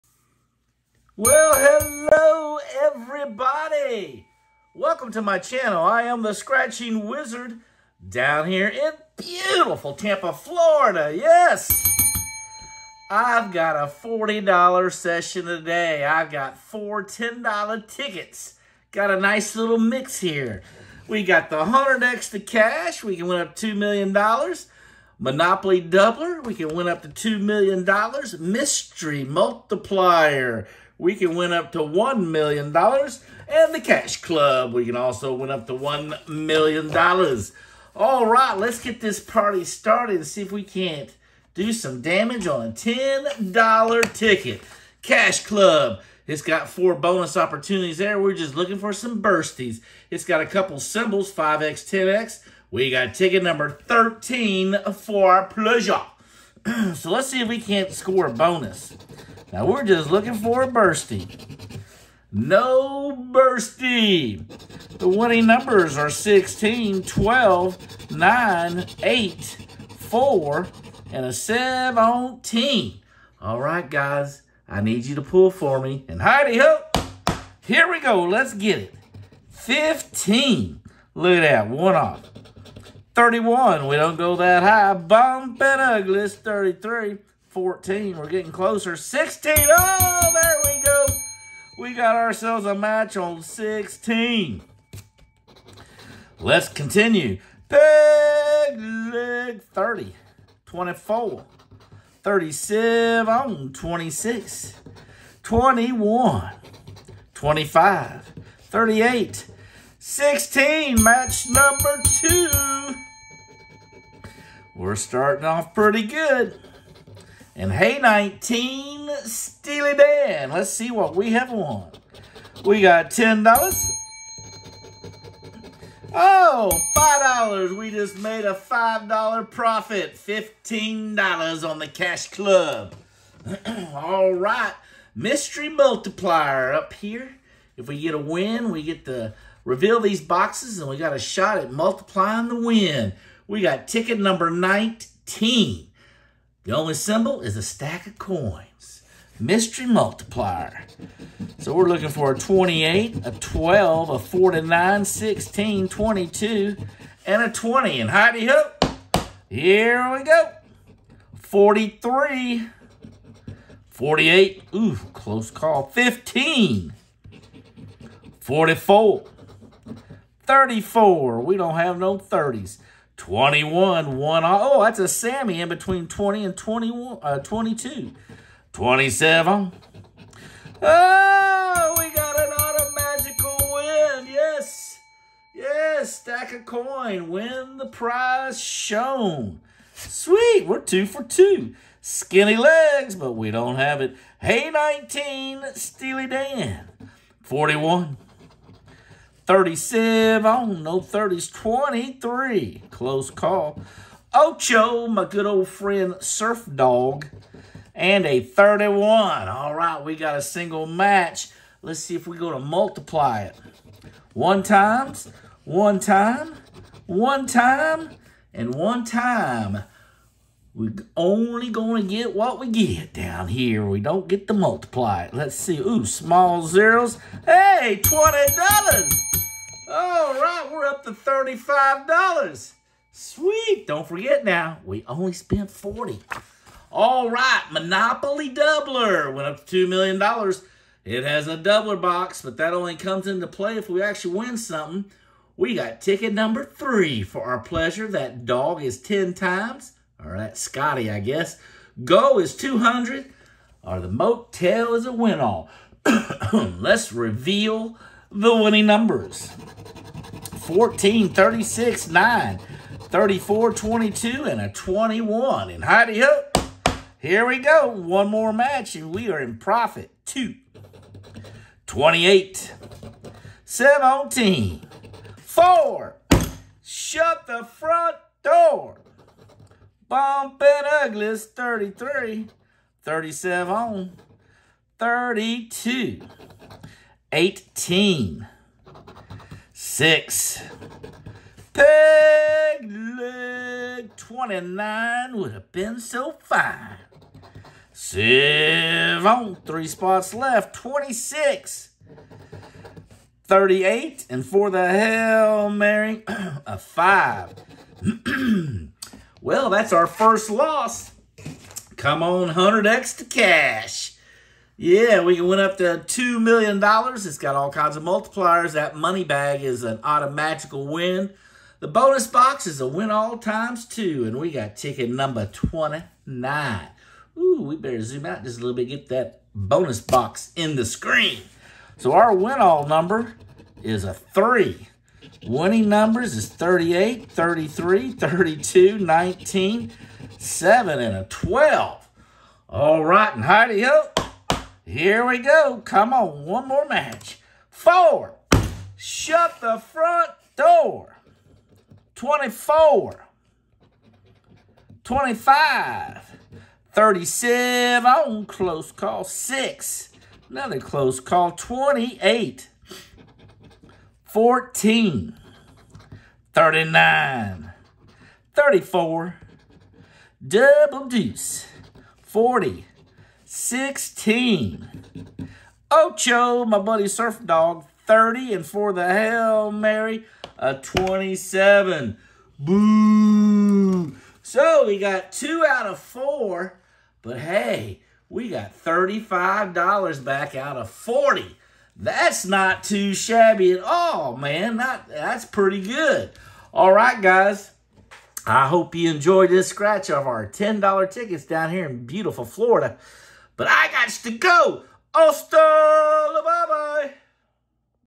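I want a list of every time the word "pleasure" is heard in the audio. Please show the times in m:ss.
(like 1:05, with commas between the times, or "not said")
0:55, 4:07.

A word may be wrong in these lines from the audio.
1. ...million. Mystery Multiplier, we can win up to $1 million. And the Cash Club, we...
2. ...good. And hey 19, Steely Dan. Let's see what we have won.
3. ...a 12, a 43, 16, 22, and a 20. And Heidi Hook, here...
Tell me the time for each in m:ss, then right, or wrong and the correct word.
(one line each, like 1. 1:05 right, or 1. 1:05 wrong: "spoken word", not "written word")
1. 0:27 right
2. 1:56 right
3. 2:33 wrong: "49", not "43".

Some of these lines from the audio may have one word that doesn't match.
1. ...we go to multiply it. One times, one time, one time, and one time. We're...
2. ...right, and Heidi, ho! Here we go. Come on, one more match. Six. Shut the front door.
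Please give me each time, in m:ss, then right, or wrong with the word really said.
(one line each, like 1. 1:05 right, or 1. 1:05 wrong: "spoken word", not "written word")
1. 3:32 right
2. 5:43 wrong: "Four", not "Six".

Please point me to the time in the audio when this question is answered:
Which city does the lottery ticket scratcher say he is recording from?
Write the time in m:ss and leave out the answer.
0:09.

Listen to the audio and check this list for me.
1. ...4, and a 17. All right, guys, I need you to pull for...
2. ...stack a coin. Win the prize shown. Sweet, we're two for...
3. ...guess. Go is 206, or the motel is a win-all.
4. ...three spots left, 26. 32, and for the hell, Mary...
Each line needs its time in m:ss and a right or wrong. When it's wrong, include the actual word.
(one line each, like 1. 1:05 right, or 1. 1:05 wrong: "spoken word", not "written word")
1. 1:09 right
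2. 3:06 right
3. 4:11 wrong: "200", not "206"
4. 4:59 wrong: "38", not "32".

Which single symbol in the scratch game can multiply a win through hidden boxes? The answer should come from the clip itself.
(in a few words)
a stack of coins.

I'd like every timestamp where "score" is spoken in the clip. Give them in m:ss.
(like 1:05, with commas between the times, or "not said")
0:57.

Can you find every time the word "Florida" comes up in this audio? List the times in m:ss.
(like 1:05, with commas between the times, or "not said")
0:10, 6:42.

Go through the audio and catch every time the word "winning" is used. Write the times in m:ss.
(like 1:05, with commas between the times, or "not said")
1:05, 4:18, 5:35.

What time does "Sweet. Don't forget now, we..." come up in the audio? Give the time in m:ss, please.
3:53.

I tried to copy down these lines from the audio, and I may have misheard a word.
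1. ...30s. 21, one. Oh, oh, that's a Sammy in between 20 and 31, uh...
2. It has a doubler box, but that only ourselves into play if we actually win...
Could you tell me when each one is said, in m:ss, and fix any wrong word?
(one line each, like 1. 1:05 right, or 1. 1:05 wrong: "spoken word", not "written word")
1. 2:52 wrong: "21", not "31"
2. 4:01 wrong: "comes", not "ourselves".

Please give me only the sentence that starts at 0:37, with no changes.
All right, let's get this party started and see if we can't do some damage on a $10 ticket.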